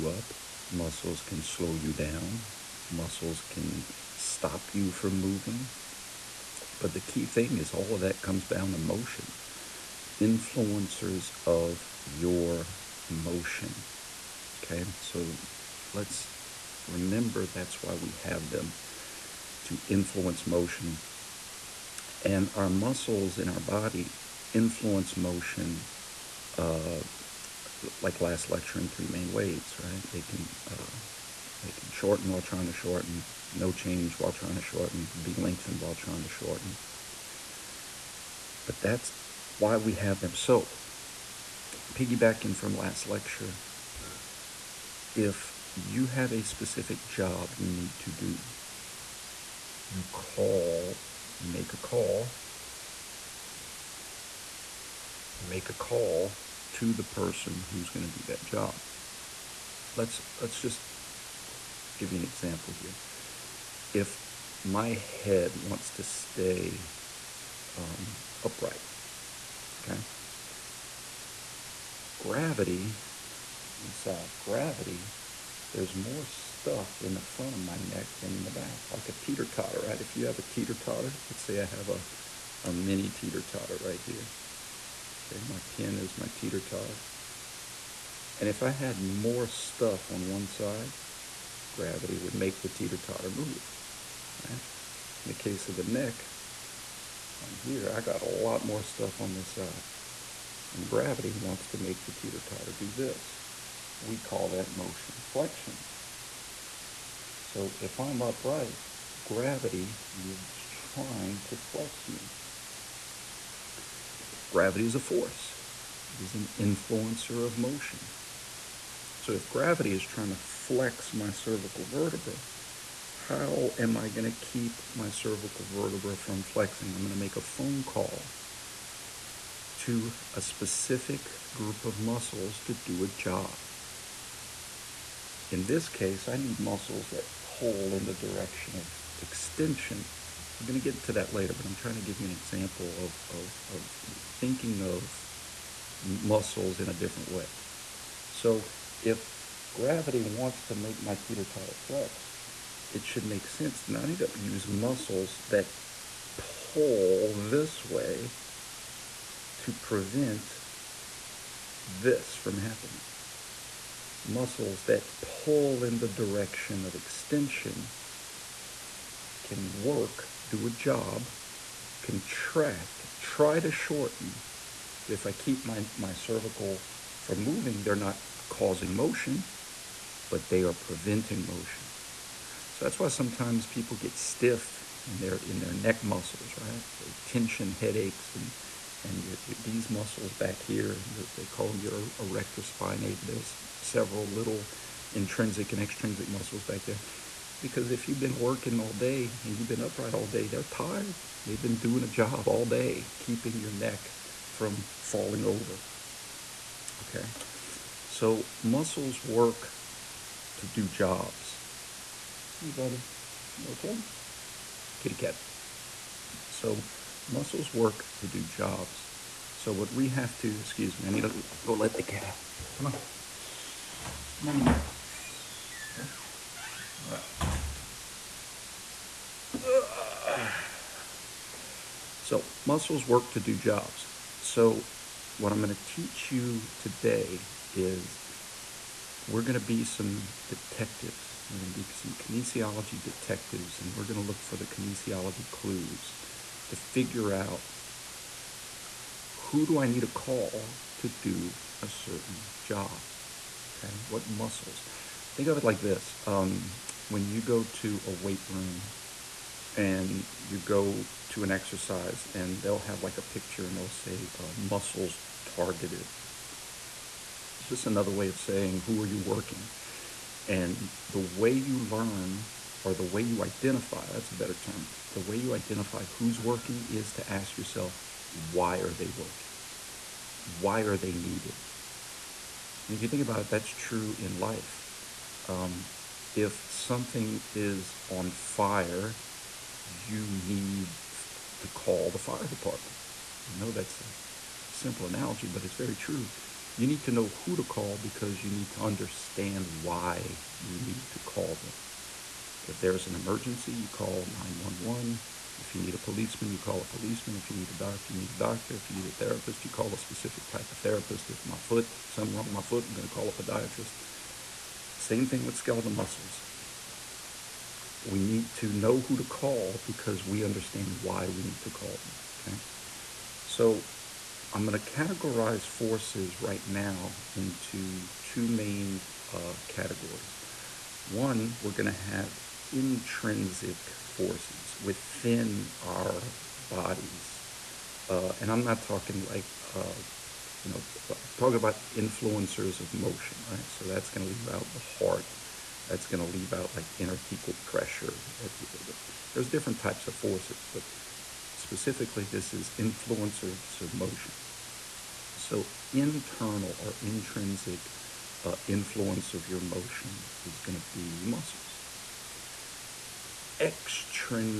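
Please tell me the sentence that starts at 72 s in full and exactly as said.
Gravity, inside gravity, there's more stuff in the front of my neck than in the back, like a teeter-totter, right?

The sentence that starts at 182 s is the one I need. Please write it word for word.
So that's why sometimes people get stiff in their in their neck muscles, right?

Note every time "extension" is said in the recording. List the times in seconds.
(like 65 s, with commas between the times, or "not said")
139 s, 166 s.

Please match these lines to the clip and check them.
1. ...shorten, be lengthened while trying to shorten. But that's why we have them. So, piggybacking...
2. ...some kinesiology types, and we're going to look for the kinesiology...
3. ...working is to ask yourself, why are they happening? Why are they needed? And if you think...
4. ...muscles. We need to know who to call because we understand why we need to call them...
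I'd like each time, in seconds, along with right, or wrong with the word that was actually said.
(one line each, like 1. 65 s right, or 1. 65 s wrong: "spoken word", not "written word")
1. 34 s right
2. 241 s wrong: "detectives", not "types"
3. 276 s wrong: "working", not "happening"
4. 315 s right.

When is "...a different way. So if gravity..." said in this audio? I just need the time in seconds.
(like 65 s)
146 s.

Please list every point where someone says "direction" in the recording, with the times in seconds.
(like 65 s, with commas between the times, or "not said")
138 s, 166 s.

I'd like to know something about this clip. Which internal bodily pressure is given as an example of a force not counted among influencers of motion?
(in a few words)
Intrathecal pressure.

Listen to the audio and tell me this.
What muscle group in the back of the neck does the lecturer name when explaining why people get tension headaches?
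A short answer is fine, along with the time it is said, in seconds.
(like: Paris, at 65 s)
Erector spinae, at 192 s.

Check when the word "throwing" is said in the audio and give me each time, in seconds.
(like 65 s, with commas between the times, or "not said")
not said.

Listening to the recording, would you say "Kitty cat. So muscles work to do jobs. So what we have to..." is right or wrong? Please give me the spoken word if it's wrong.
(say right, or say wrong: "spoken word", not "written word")
right.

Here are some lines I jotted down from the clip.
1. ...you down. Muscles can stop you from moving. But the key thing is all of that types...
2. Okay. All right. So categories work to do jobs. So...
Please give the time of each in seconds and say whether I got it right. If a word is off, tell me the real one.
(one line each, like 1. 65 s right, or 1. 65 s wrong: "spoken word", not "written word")
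1. 1 s wrong: "comes", not "types"
2. 227 s wrong: "muscles", not "categories".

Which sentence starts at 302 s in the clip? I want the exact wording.
If there's an emergency, you call 911.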